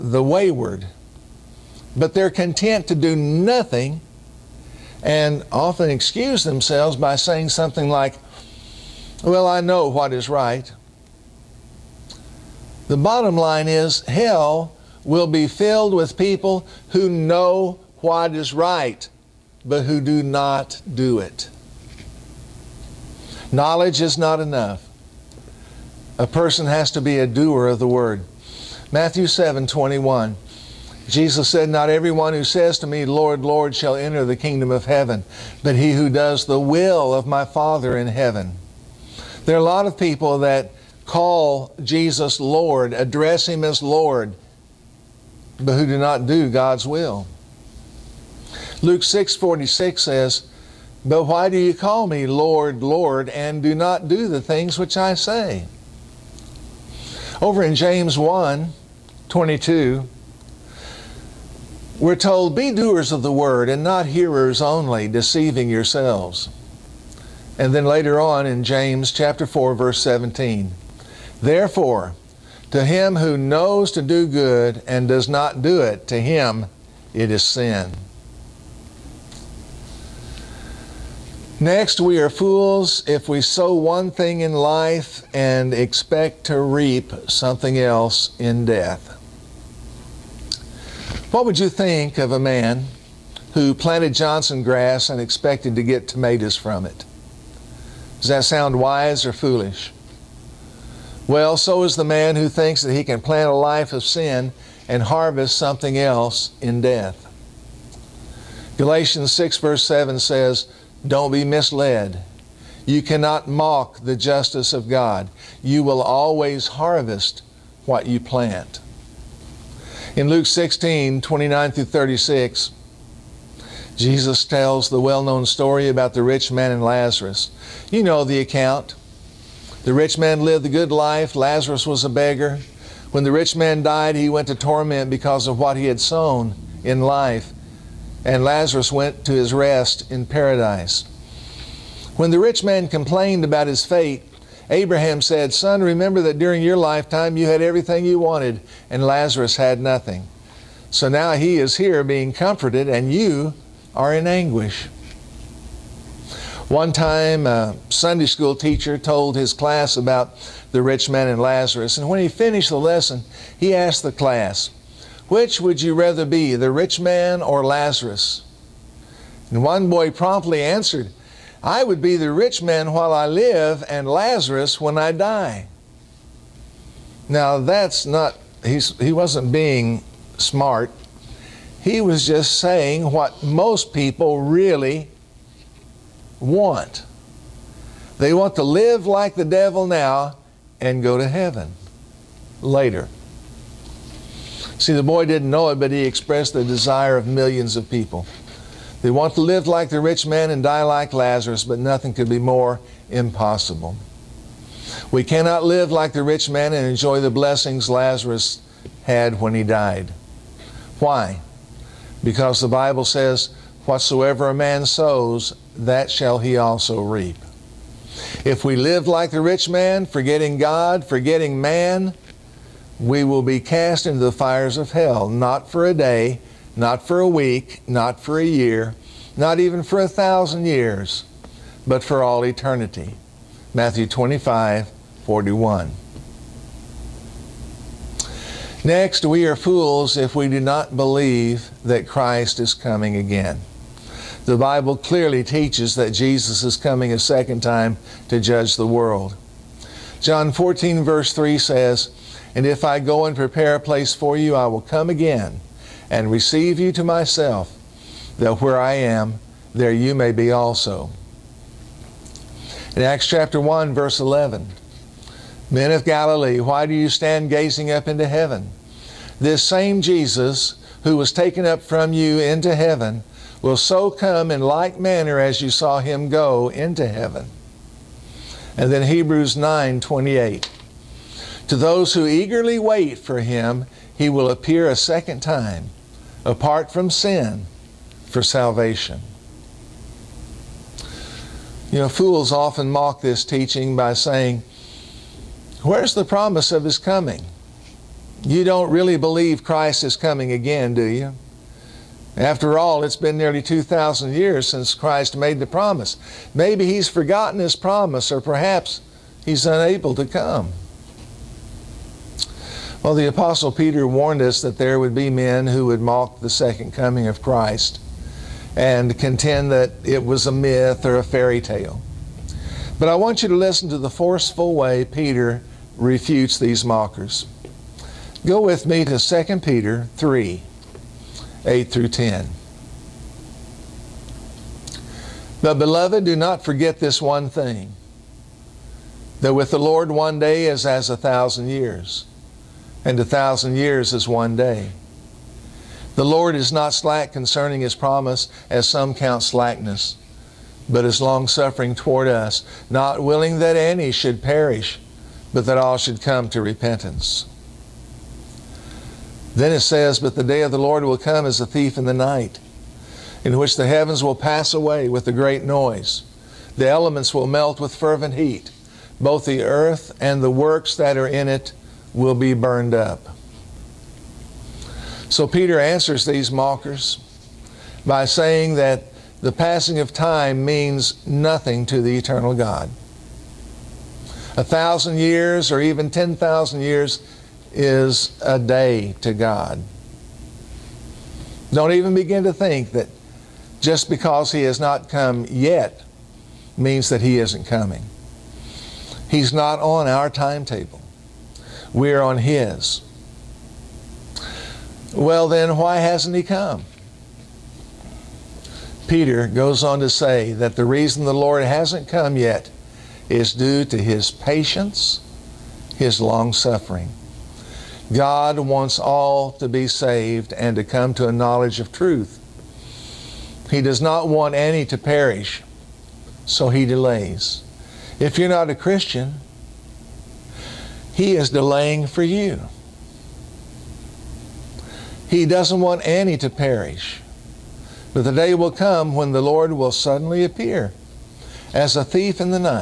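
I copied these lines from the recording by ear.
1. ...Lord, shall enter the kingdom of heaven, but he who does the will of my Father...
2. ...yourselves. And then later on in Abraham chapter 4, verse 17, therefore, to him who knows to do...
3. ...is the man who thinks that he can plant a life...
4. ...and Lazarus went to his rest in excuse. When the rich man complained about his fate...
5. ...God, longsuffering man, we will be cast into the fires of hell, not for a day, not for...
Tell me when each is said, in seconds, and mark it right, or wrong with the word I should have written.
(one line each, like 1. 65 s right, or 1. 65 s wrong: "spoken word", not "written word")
1. 33 s right
2. 65 s wrong: "James", not "Abraham"
3. 101 s right
4. 138 s wrong: "paradise", not "excuse"
5. 220 s wrong: "forgetting", not "longsuffering".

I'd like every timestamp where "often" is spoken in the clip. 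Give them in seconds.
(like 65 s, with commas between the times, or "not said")
5 s, 292 s.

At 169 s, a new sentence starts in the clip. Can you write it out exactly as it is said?
And one boy promptly answered, I would be the rich man while I live and Lazarus when I die.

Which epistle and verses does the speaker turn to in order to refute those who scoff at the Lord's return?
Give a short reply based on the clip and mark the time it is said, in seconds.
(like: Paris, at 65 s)
2 Peter 3:8-10, at 329 s.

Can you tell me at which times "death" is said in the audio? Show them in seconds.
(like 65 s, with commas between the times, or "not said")
88 s, 106 s.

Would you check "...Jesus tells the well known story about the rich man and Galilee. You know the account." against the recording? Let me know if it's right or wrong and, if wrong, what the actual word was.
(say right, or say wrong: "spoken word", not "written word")
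wrong: "Lazarus", not "Galilee".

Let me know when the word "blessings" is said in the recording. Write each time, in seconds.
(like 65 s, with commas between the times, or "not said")
207 s.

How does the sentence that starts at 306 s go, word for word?
Maybe he's forgotten his promise, or perhaps he's unable to come.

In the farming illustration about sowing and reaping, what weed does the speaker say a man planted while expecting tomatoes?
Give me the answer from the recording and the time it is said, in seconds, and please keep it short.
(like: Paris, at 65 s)
Johnson grass, at 94 s.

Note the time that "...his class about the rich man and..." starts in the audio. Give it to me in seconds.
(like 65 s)
159 s.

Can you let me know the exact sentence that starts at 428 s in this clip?
If you're not a Christian, he is delaying for you.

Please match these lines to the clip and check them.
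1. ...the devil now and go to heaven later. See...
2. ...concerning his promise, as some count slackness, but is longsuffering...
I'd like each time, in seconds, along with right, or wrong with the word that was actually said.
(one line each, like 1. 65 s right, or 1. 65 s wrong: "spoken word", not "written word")
1. 189 s right
2. 347 s right.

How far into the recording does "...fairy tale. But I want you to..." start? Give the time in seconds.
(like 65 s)
321 s.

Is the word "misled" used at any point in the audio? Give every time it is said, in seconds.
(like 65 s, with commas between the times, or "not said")
111 s.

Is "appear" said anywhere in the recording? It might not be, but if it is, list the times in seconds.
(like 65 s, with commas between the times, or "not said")
284 s, 440 s.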